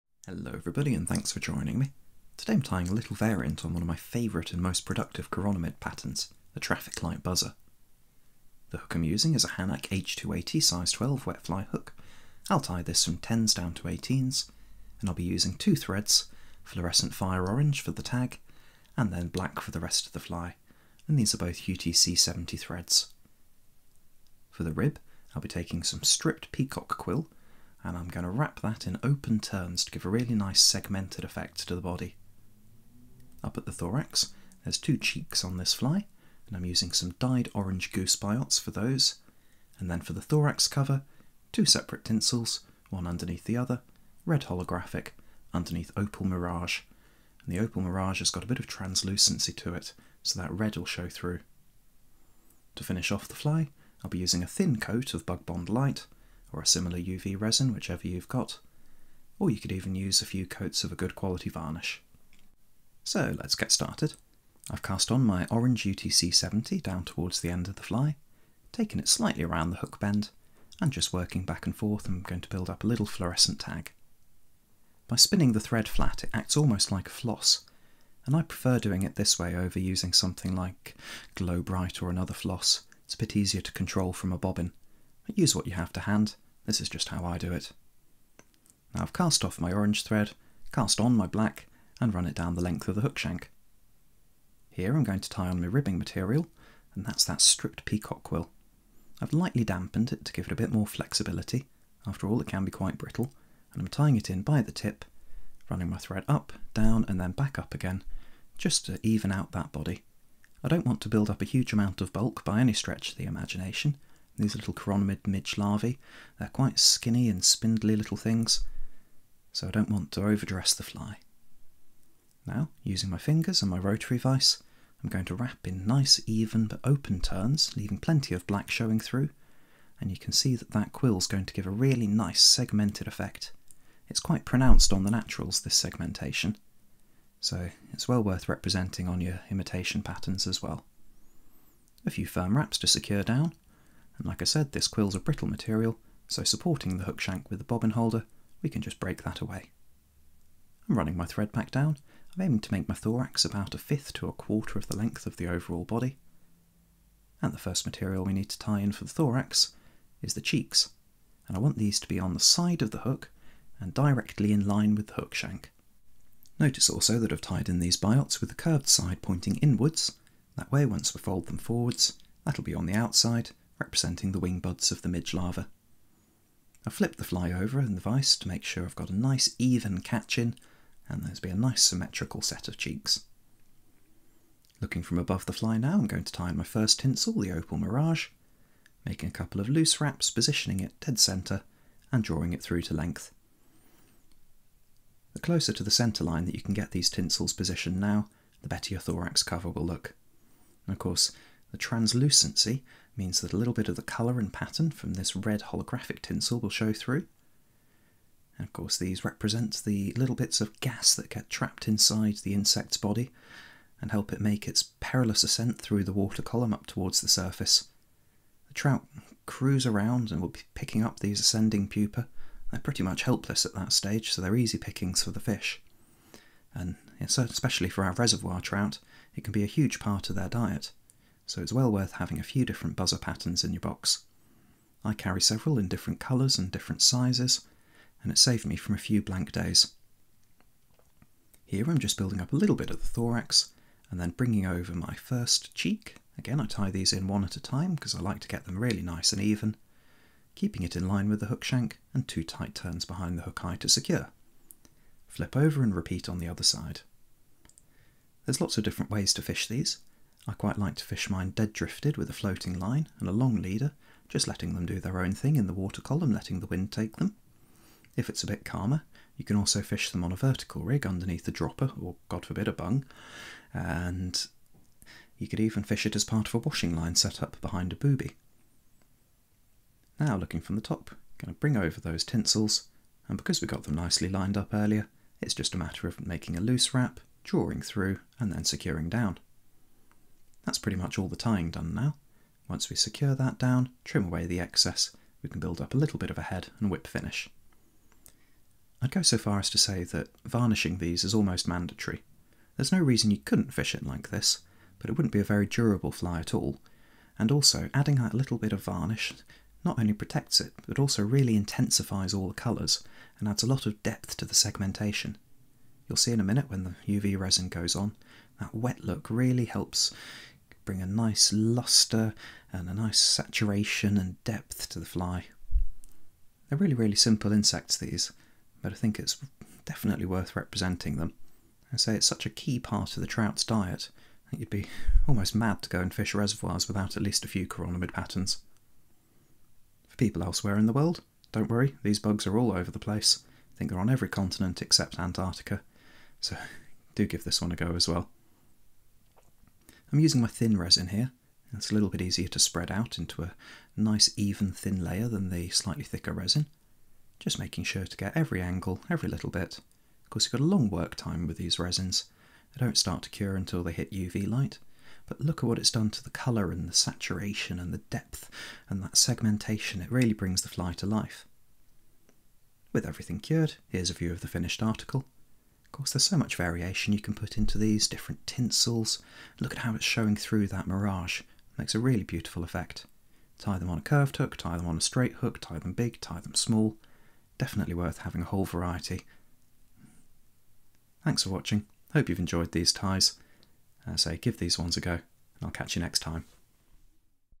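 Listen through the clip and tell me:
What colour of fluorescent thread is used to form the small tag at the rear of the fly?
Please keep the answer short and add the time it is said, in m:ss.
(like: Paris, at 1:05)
fire orange, at 0:17.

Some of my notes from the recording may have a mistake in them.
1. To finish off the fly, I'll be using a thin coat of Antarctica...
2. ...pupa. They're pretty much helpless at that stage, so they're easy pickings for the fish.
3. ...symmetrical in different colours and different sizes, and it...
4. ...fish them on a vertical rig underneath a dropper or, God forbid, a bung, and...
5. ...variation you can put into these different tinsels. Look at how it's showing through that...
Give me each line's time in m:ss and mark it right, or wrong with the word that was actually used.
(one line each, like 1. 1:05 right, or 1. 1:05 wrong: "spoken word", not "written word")
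1. 0:52 wrong: "Bug", not "Antarctica"
2. 3:41 right
3. 3:55 wrong: "several", not "symmetrical"
4. 4:29 right
5. 6:16 right.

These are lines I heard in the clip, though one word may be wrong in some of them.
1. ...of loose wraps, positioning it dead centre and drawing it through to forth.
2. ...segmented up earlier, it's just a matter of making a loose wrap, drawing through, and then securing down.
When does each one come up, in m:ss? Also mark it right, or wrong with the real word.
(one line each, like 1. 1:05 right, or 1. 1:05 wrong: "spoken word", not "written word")
1. 3:09 wrong: "length", not "forth"
2. 4:44 wrong: "lined", not "segmented".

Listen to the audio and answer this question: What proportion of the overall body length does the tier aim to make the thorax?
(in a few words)
a fifth to a quarter.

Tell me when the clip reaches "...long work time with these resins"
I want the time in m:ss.
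6:00.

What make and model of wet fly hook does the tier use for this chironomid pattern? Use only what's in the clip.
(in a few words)
Hanak H280.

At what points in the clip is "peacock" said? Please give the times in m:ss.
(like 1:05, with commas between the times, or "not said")
0:26, 1:37.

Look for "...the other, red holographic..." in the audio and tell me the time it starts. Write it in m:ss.
0:43.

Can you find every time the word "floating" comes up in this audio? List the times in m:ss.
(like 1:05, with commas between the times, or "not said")
4:22.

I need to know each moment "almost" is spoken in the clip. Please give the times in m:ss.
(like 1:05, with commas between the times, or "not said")
1:16, 5:01, 5:35.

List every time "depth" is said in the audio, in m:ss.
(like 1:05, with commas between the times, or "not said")
5:14, 5:24, 6:07.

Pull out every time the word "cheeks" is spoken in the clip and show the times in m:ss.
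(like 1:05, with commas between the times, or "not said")
0:34, 2:40, 3:02, 4:05.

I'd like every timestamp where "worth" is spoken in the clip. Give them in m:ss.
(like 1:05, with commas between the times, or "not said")
2:18, 3:51, 5:30, 6:27.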